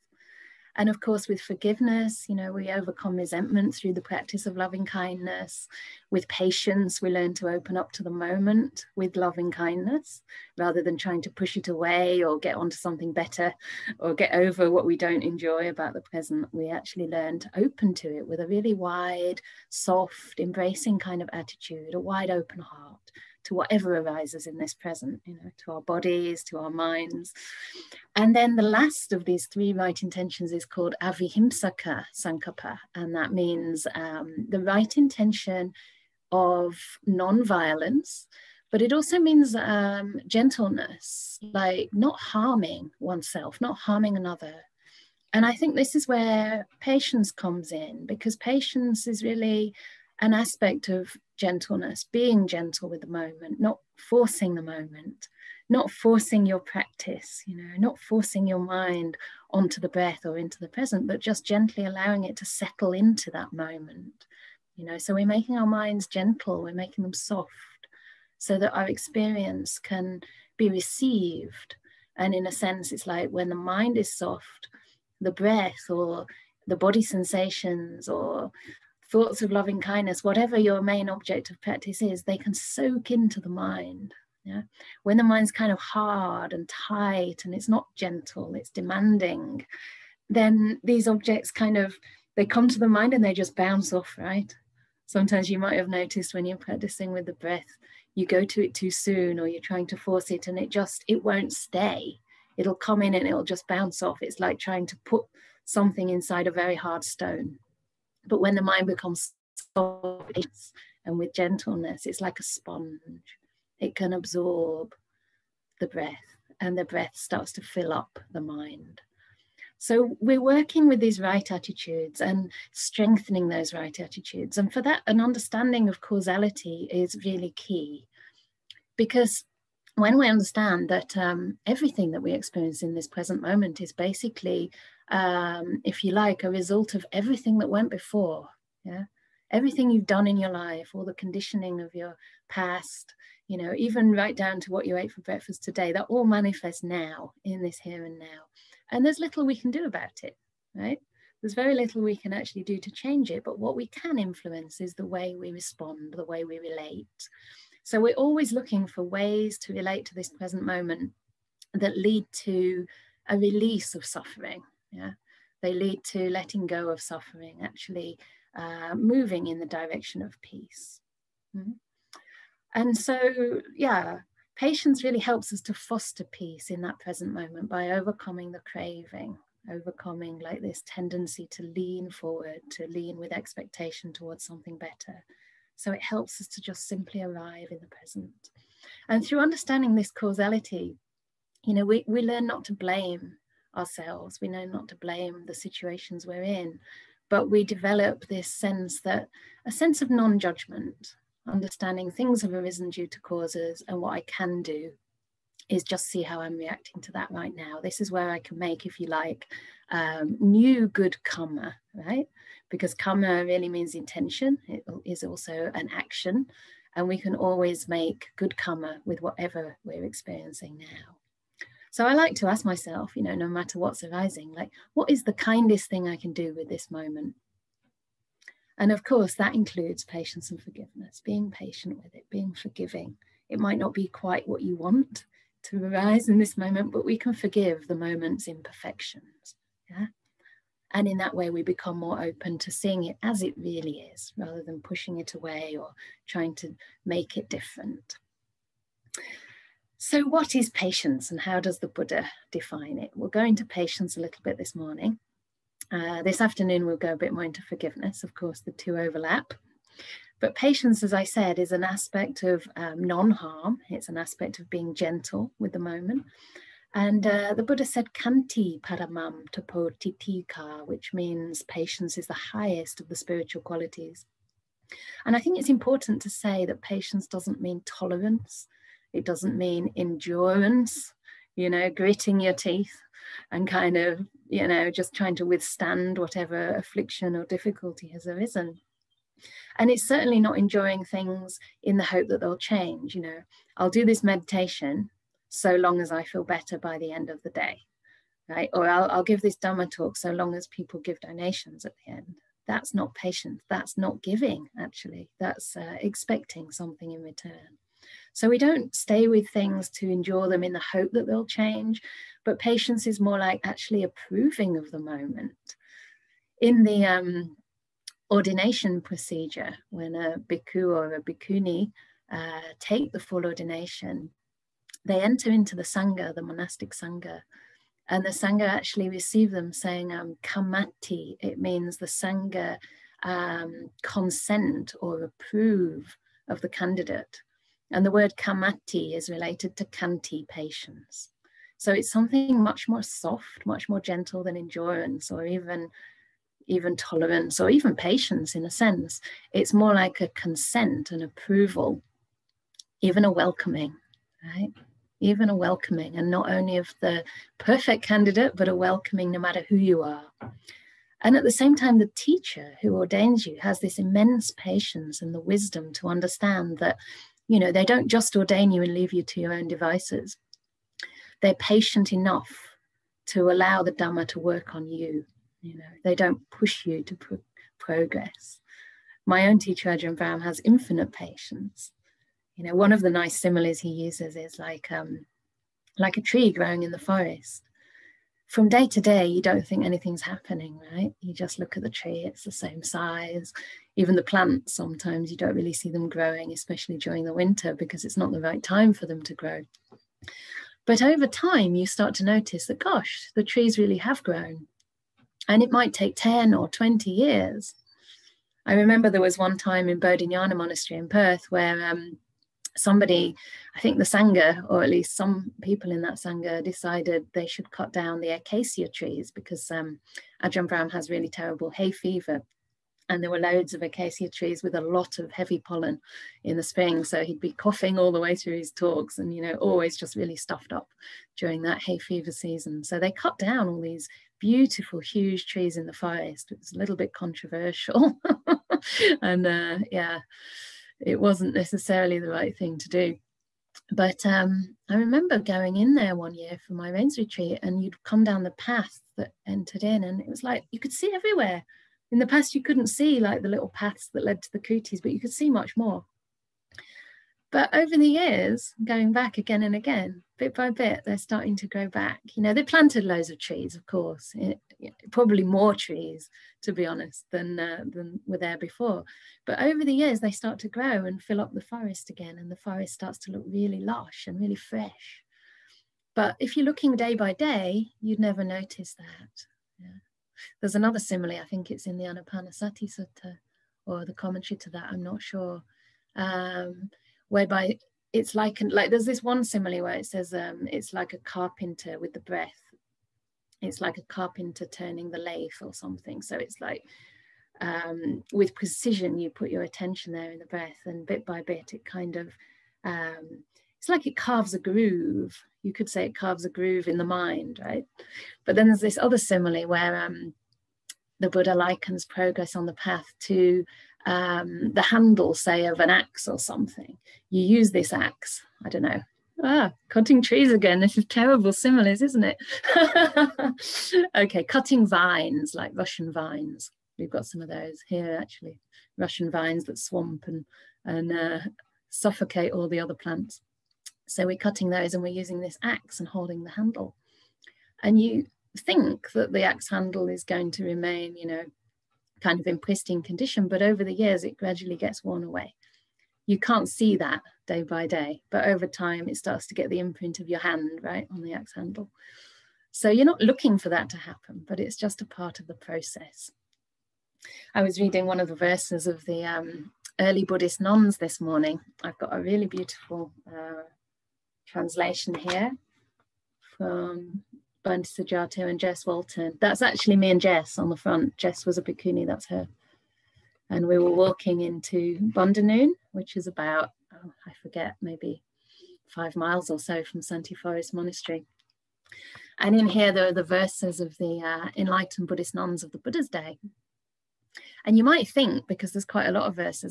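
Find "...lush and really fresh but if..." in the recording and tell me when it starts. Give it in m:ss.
7:53.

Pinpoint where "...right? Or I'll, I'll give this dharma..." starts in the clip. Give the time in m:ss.
4:58.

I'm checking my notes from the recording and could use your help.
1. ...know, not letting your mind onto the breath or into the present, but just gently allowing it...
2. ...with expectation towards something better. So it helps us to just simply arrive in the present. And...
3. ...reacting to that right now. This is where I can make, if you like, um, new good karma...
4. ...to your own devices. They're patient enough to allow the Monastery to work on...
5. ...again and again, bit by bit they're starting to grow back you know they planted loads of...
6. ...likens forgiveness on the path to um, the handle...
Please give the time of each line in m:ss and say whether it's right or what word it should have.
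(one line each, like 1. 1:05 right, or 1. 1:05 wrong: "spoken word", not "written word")
1. 0:57 wrong: "forcing", not "letting"
2. 3:03 right
3. 3:26 right
4. 6:09 wrong: "Dhamma", not "Monastery"
5. 7:39 right
6. 8:31 wrong: "progress", not "forgiveness".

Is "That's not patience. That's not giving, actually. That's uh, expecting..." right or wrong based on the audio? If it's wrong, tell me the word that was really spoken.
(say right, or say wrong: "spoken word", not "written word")
right.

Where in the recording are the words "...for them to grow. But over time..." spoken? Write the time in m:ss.
6:38.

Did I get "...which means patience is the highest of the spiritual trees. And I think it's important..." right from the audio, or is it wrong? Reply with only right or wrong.
wrong.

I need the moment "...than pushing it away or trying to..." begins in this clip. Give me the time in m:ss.
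4:04.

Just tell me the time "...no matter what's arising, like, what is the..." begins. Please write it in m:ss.
3:43.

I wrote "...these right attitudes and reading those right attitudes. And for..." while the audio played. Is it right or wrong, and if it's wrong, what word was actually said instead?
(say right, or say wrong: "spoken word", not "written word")
wrong: "strengthening", not "reading".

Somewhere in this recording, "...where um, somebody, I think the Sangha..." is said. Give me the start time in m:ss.
6:51.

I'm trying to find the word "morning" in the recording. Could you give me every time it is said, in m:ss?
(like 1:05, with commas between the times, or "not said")
4:14, 9:21.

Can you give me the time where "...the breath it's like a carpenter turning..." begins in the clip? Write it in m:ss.
8:12.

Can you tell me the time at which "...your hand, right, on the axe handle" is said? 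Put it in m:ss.
9:10.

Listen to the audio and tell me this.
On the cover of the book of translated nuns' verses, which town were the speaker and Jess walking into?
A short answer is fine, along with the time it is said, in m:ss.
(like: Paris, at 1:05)
Bundanoon, at 9:34.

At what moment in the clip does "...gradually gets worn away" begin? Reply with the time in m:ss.
9:04.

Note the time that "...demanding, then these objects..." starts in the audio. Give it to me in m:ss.
1:28.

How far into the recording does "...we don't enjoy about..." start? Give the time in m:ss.
0:14.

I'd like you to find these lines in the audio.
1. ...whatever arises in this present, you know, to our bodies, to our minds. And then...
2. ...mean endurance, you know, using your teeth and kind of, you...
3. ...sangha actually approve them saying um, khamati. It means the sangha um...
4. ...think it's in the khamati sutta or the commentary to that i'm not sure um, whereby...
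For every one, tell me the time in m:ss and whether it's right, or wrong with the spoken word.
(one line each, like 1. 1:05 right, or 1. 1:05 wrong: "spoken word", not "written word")
1. 0:23 right
2. 4:39 wrong: "gritting", not "using"
3. 5:28 wrong: "receive", not "approve"
4. 8:01 wrong: "anapanasati", not "khamati".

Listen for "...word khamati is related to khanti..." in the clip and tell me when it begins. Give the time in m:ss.
5:38.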